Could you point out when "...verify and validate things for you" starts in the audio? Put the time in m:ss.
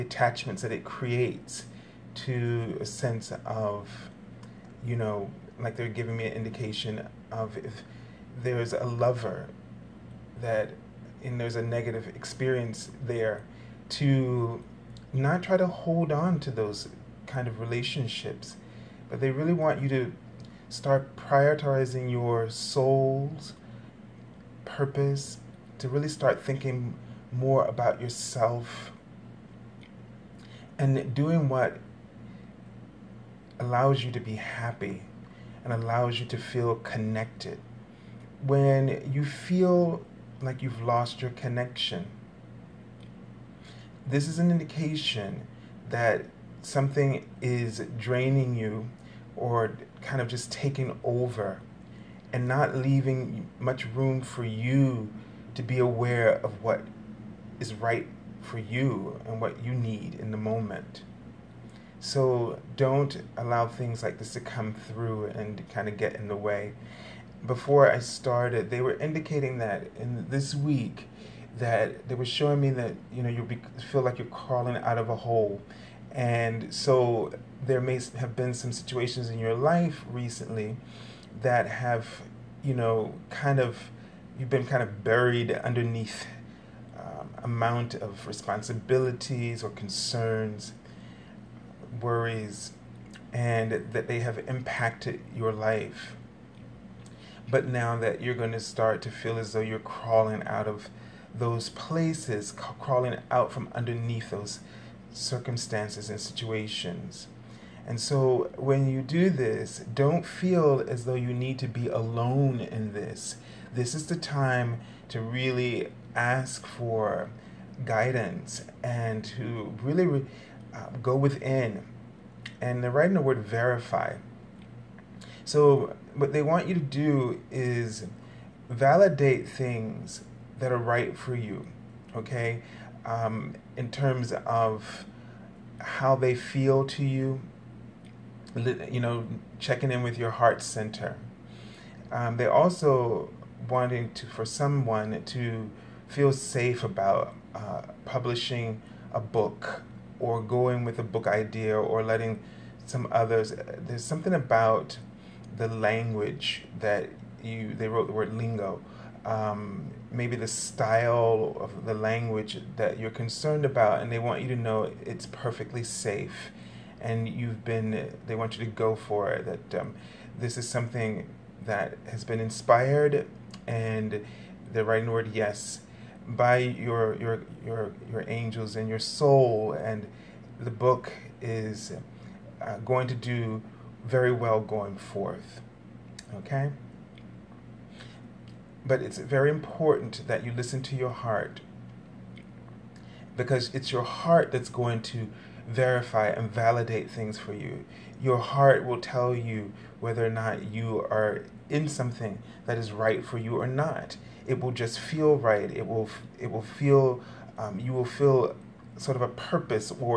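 3:15.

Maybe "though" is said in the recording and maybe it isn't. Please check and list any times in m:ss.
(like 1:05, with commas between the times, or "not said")
1:39, 1:51.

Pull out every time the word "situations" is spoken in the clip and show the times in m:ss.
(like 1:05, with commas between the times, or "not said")
1:18, 1:46.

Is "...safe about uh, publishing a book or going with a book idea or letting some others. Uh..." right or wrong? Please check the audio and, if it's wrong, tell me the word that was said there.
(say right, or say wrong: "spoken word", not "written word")
right.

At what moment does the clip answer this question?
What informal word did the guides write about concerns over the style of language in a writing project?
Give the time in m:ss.
2:38.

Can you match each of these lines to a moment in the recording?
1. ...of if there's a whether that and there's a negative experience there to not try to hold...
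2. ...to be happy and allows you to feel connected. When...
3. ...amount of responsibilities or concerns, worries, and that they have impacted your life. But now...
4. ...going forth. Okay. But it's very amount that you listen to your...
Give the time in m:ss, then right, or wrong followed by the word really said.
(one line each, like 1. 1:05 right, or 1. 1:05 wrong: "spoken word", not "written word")
1. 0:07 wrong: "lover", not "whether"
2. 0:34 right
3. 1:27 right
4. 3:04 wrong: "important", not "amount".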